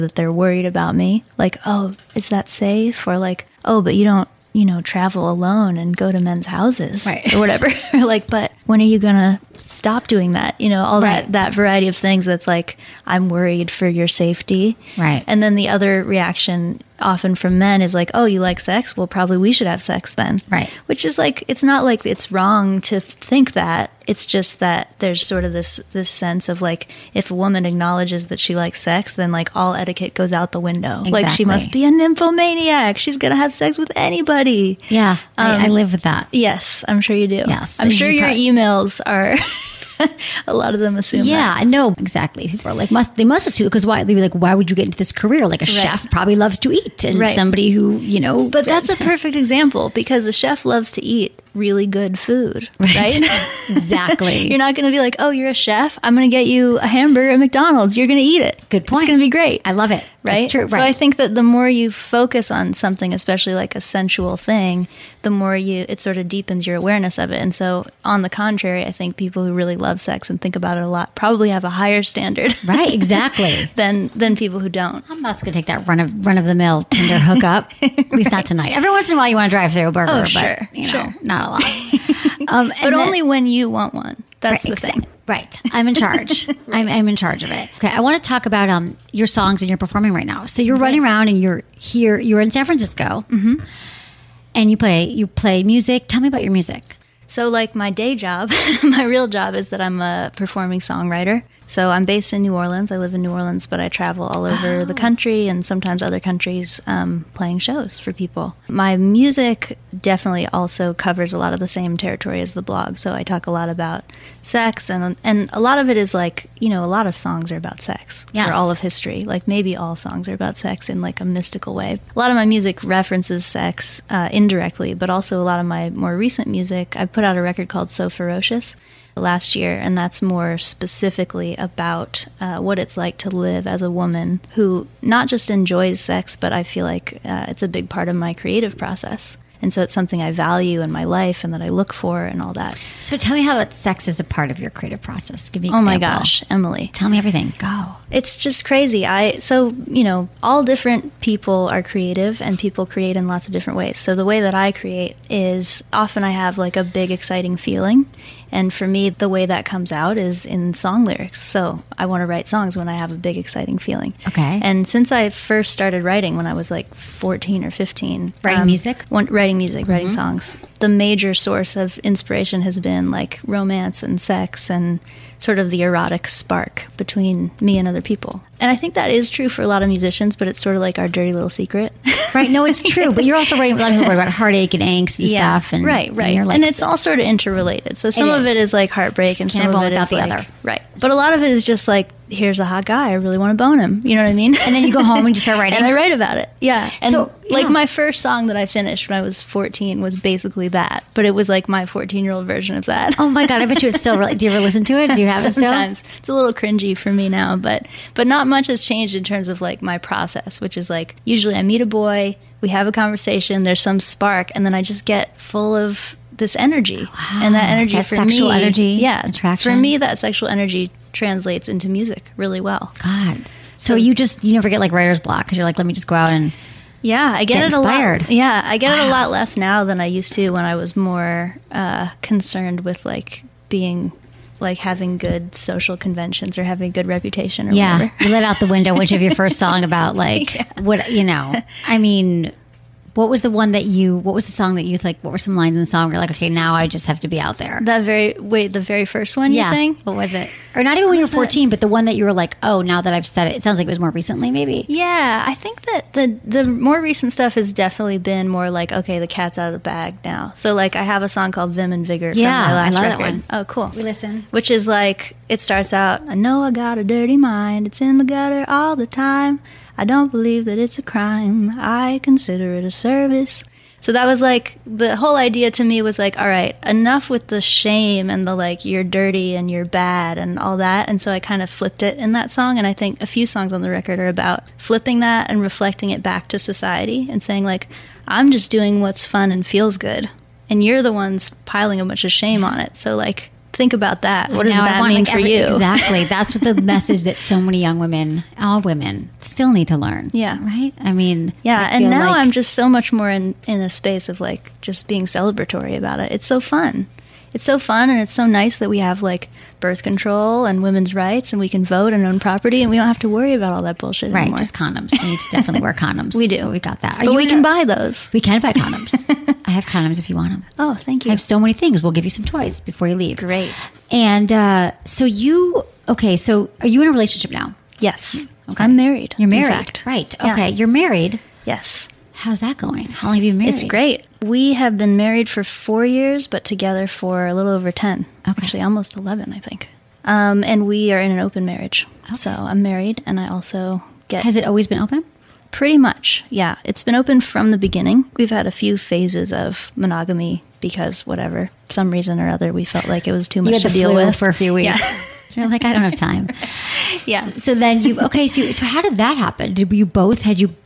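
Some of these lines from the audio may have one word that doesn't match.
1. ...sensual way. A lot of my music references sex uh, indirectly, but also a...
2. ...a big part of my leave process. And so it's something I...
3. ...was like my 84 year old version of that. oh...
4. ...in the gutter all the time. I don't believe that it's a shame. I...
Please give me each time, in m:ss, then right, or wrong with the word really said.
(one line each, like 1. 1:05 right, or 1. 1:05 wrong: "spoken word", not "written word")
1. 2:01 wrong: "mystical", not "sensual"
2. 2:17 wrong: "creative", not "leave"
3. 3:21 wrong: "14", not "84"
4. 4:28 wrong: "crime", not "shame".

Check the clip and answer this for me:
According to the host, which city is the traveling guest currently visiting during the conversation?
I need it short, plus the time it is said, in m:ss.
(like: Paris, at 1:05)
San Francisco, at 1:32.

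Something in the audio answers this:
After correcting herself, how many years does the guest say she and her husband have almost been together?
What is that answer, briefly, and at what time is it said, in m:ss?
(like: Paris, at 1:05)
11, at 5:38.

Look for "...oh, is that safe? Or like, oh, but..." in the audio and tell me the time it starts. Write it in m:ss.
0:01.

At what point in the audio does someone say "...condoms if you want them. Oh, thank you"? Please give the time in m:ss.
5:19.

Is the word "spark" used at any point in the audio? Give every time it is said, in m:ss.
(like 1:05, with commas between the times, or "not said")
2:56, 3:33.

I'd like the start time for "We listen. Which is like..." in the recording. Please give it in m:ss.
4:23.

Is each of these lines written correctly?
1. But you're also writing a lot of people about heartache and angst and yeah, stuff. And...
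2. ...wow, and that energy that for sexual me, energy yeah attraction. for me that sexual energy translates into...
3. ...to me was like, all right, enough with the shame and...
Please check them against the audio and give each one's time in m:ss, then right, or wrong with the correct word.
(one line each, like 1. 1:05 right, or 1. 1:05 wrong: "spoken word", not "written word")
1. 3:03 right
2. 3:37 right
3. 4:35 right.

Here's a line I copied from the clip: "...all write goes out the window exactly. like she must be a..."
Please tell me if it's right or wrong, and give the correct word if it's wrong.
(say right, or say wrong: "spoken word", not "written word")
wrong: "etiquette", not "write".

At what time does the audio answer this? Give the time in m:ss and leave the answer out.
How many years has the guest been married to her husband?
5:35.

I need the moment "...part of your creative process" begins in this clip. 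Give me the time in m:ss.
2:24.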